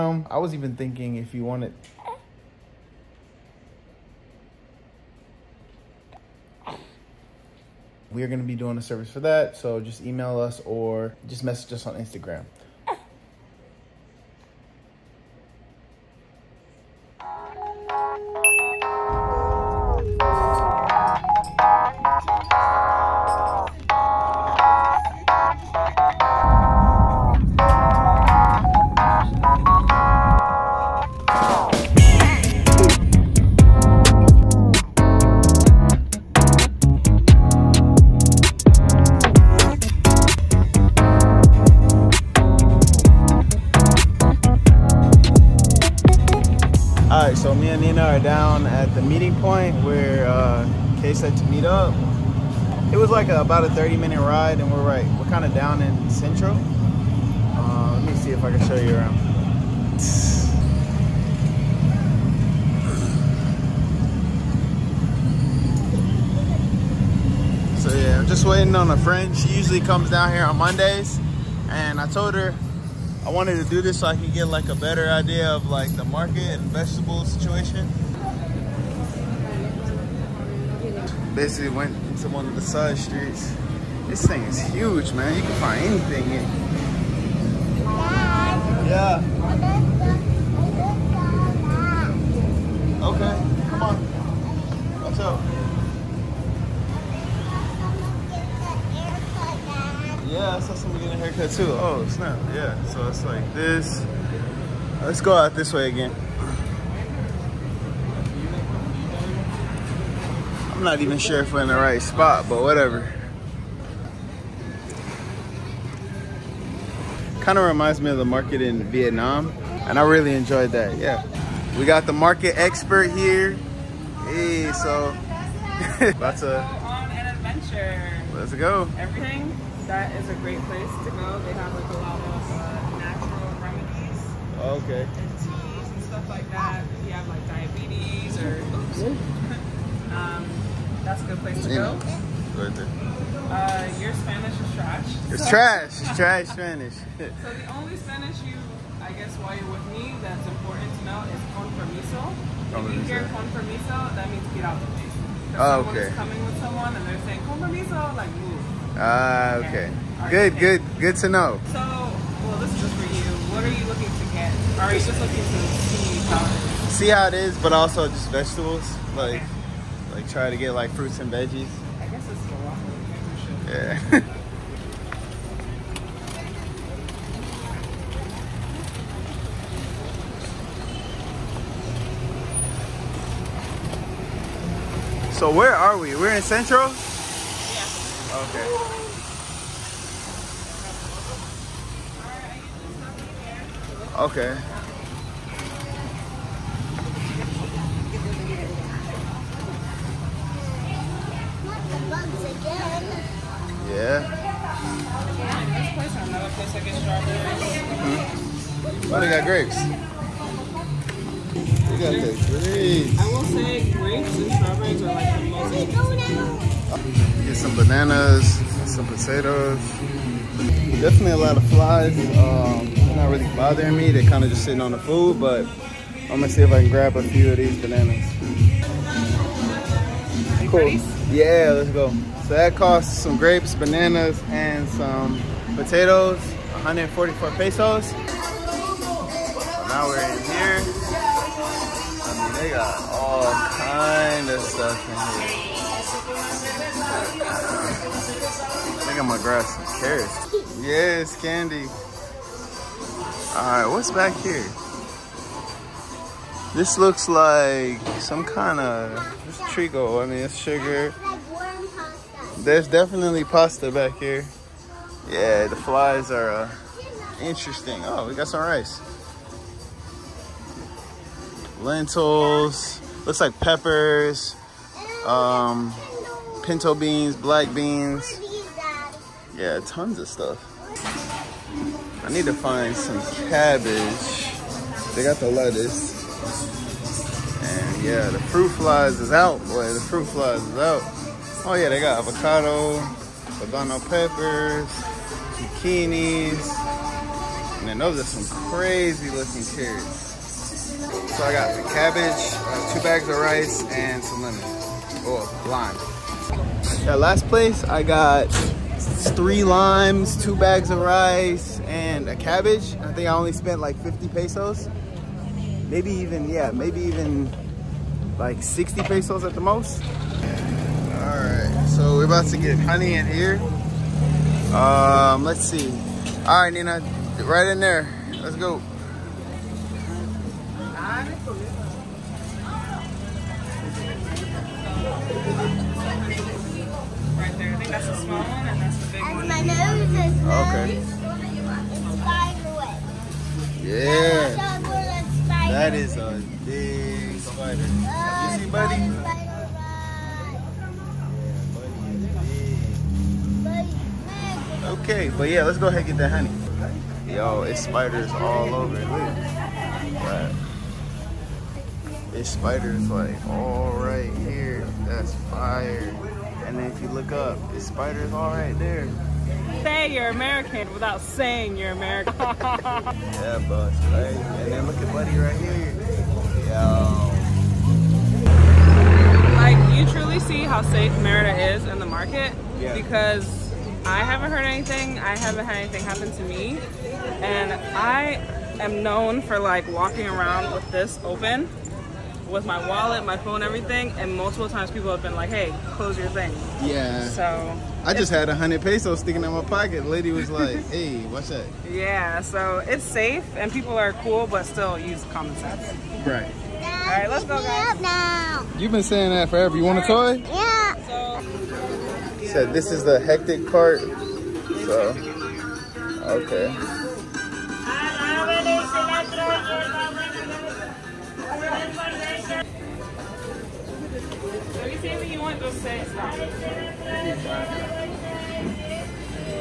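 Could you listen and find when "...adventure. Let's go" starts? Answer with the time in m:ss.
2:07.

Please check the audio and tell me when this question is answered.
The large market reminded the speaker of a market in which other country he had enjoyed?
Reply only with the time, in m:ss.
1:58.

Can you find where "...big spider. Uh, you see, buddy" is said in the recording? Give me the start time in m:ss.
5:46.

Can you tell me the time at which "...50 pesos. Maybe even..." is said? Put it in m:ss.
5:14.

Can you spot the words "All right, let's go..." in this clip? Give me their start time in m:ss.
6:46.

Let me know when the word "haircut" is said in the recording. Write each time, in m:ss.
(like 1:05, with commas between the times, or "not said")
1:41.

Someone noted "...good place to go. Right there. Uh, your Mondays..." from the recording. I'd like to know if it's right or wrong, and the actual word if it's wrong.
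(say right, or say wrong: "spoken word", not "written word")
wrong: "Spanish", not "Mondays".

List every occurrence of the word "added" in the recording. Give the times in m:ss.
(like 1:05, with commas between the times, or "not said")
not said.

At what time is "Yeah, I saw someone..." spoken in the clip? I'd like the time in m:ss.
1:40.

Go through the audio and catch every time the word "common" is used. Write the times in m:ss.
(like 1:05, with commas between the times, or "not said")
6:45.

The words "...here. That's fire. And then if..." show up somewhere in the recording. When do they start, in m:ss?
6:04.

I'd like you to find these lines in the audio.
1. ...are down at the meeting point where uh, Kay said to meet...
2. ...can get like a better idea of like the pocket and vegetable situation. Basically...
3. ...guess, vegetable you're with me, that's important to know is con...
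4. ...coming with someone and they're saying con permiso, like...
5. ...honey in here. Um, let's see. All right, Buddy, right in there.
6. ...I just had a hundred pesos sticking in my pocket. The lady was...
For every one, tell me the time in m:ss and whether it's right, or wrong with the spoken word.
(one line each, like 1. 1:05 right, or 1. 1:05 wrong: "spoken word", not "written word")
1. 0:48 right
2. 1:14 wrong: "market", not "pocket"
3. 2:29 wrong: "while", not "vegetable"
4. 2:36 right
5. 5:22 wrong: "Nina", not "Buddy"
6. 6:38 right.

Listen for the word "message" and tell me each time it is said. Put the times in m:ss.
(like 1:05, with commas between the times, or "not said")
0:11.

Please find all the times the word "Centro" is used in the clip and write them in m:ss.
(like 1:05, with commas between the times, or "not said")
0:56, 3:06.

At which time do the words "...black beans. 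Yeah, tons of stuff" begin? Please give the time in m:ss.
4:37.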